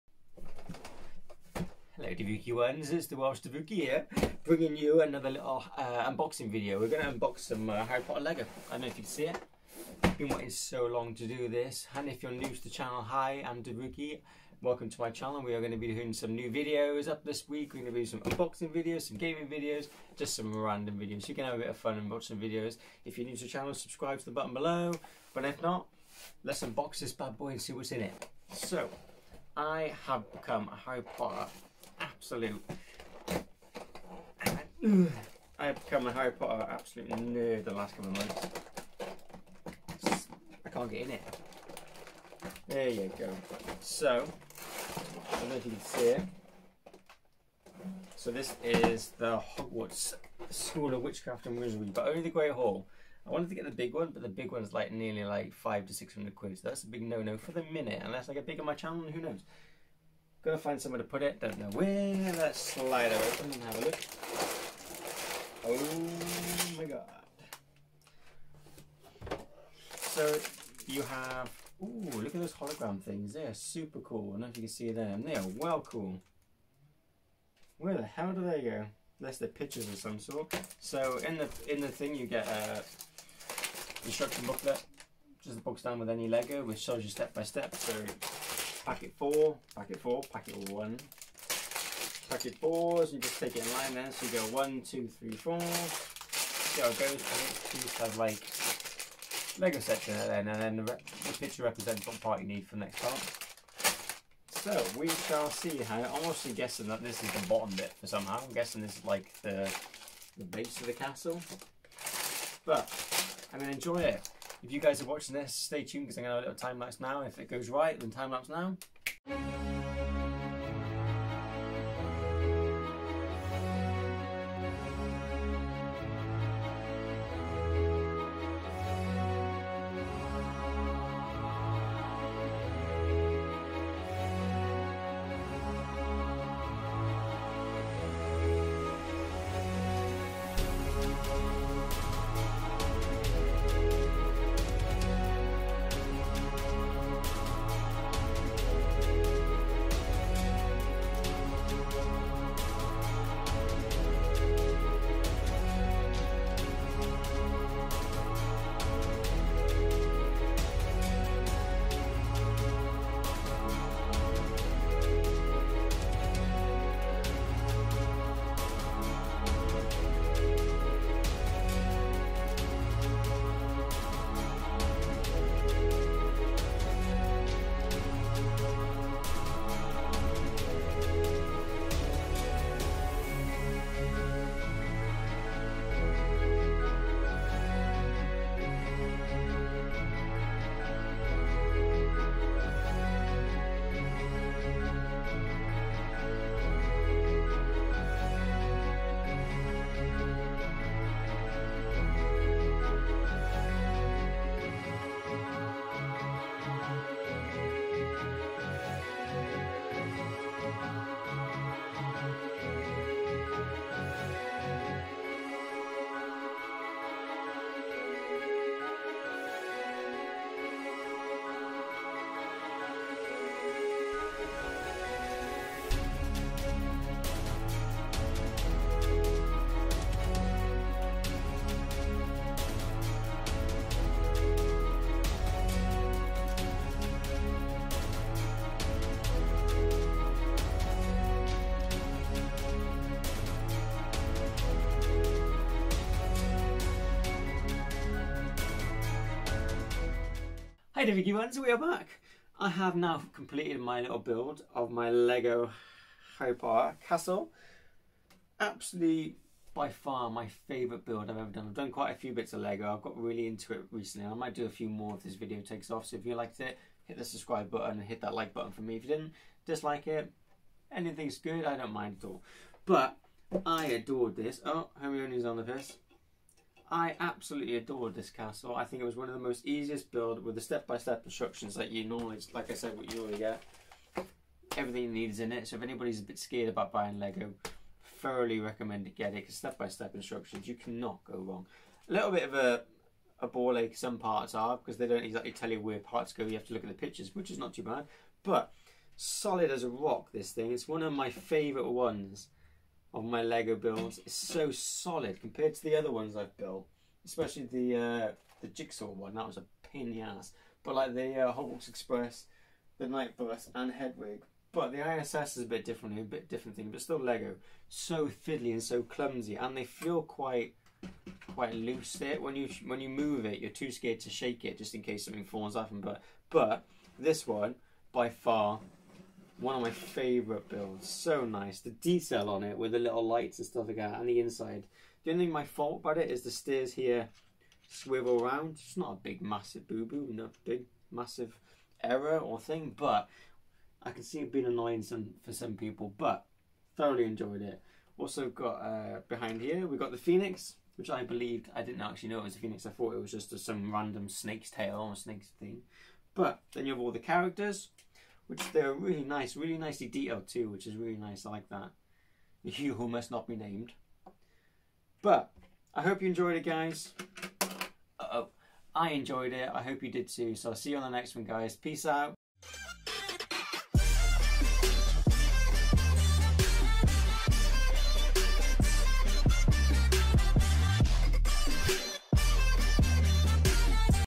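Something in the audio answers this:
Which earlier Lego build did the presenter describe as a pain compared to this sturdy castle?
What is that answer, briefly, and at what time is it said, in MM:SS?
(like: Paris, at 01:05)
The jigsaw one, at 05:08.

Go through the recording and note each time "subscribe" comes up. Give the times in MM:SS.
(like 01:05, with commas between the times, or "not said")
00:23, 04:27.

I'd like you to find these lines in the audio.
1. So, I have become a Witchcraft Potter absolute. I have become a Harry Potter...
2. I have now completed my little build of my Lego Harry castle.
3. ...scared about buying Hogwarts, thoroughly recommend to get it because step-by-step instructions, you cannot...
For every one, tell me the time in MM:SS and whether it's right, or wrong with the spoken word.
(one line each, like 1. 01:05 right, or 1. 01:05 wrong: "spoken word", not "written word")
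1. 00:28 wrong: "Harry", not "Witchcraft"
2. 04:12 wrong: "Hogwarts", not "Harry"
3. 04:46 wrong: "Lego", not "Hogwarts".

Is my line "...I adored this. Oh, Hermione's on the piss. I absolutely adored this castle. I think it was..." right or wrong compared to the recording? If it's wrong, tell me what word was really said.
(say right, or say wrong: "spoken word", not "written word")
right.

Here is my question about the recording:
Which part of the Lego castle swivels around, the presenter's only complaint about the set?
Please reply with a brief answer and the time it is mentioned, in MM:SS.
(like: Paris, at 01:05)
The stairs, at 05:36.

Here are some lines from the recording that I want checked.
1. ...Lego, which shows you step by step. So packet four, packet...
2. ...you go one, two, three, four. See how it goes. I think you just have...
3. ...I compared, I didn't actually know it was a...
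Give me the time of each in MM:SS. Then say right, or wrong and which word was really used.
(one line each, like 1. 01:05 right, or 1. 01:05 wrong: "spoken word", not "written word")
1. 01:26 right
2. 01:34 right
3. 05:51 wrong: "believed", not "compared".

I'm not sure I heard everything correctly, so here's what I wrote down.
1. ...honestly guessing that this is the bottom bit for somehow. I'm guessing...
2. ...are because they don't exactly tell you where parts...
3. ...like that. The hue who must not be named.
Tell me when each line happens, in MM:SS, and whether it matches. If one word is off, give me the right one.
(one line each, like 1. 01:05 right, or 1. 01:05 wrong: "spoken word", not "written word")
1. 01:46 right
2. 04:54 right
3. 06:01 right.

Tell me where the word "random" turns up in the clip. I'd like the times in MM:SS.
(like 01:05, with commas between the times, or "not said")
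00:20, 05:53.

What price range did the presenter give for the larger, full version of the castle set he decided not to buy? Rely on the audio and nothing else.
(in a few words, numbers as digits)
500 to 600 pounds.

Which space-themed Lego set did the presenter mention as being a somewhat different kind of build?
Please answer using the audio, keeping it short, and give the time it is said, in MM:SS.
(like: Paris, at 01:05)
ISS, at 05:15.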